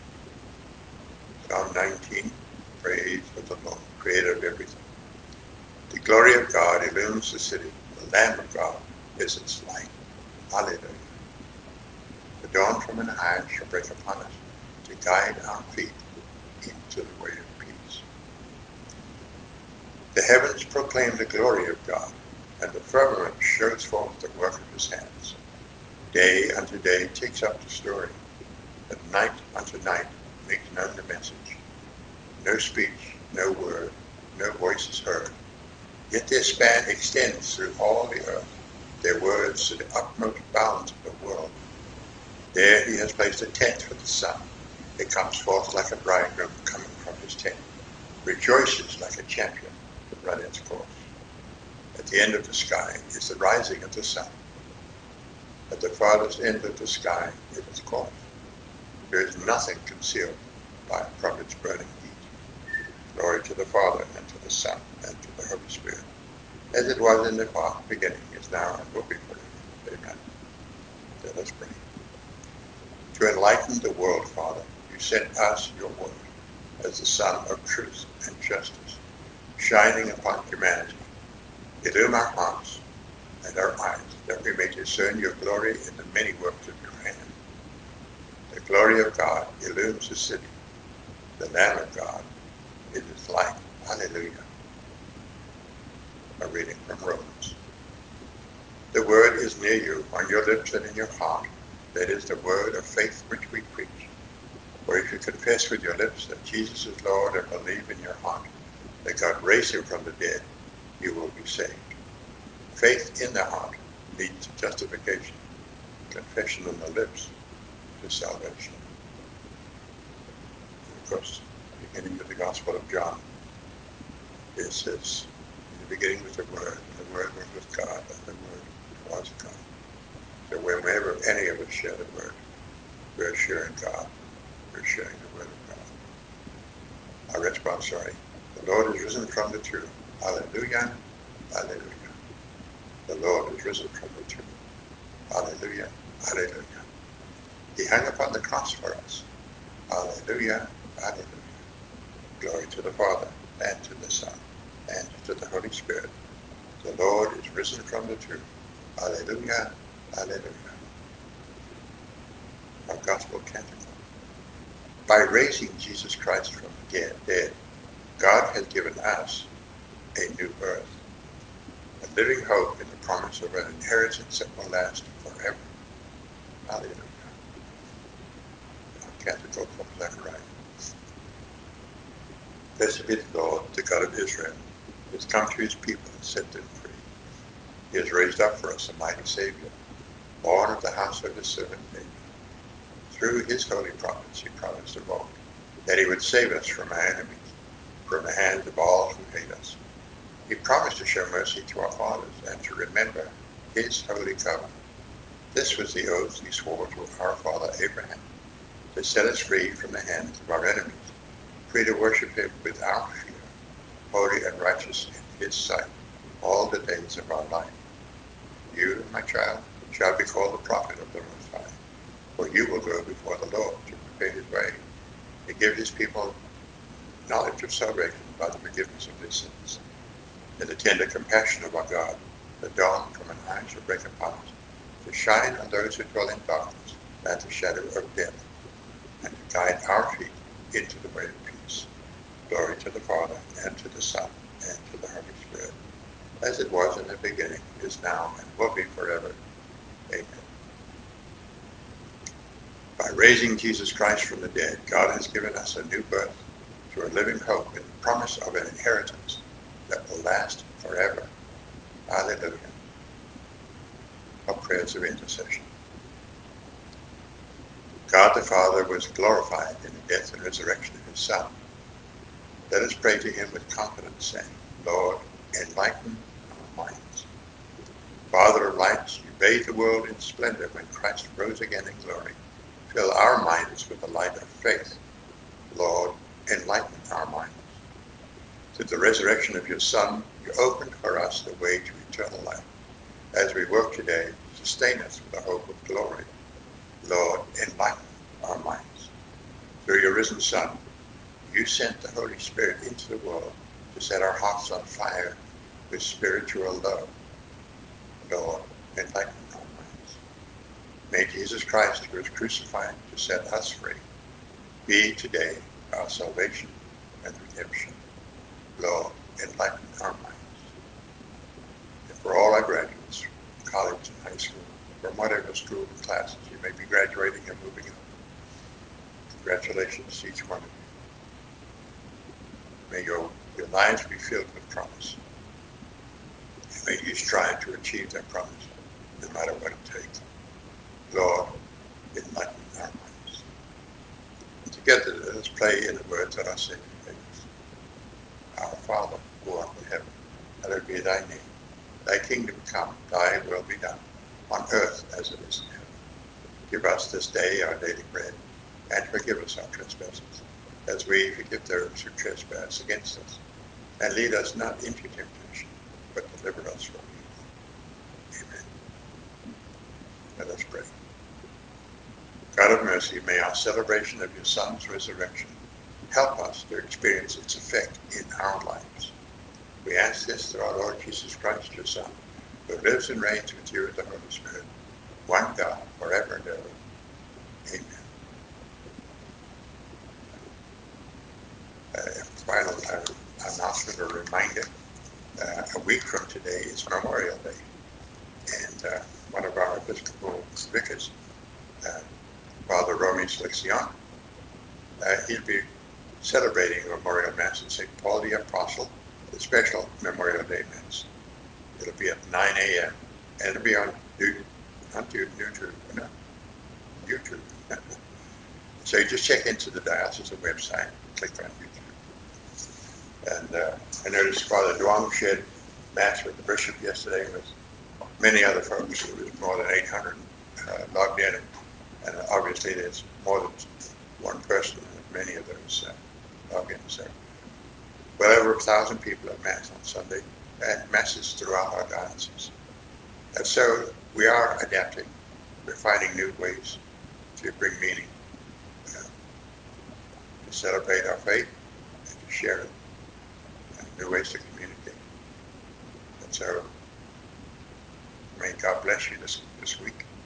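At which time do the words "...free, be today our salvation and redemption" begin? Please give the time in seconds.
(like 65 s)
313 s.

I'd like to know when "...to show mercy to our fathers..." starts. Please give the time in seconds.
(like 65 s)
200 s.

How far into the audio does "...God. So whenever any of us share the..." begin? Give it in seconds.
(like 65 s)
129 s.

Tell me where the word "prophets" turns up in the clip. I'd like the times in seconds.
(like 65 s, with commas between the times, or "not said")
193 s, 220 s.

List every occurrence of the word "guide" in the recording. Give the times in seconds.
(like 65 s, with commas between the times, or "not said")
15 s, 239 s.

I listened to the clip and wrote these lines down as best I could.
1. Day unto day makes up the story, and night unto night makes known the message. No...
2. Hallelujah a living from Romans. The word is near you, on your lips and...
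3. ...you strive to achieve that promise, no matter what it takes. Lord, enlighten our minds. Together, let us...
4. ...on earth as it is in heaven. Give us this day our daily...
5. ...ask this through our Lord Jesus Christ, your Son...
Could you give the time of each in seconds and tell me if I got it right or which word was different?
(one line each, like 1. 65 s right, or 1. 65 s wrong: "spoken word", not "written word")
1. 26 s wrong: "takes", not "makes"
2. 93 s wrong: "reading", not "living"
3. 337 s right
4. 354 s right
5. 379 s right.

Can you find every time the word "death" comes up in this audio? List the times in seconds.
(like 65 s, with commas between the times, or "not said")
238 s, 270 s.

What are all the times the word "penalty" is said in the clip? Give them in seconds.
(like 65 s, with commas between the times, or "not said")
not said.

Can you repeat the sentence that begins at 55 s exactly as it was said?
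At the farthest end of the sky it is course.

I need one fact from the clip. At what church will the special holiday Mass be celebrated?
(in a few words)
St. Paul the Apostle.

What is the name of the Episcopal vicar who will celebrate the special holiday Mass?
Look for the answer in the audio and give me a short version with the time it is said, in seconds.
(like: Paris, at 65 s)
Father Romy Seleccion, at 402 s.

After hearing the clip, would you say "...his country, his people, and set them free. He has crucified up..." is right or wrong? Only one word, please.
wrong.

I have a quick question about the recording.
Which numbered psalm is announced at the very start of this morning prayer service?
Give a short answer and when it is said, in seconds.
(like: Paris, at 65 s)
Psalm 19, at 1 s.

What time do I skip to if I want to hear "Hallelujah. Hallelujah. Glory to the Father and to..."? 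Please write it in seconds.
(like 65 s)
149 s.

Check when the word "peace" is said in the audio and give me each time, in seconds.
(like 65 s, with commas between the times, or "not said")
17 s, 241 s.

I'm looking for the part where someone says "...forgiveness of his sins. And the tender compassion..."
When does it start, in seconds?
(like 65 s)
228 s.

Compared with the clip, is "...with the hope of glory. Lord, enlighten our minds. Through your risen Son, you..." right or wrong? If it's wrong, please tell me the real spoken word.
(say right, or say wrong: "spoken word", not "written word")
right.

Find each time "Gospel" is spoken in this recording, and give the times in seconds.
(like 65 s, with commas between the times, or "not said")
122 s, 162 s.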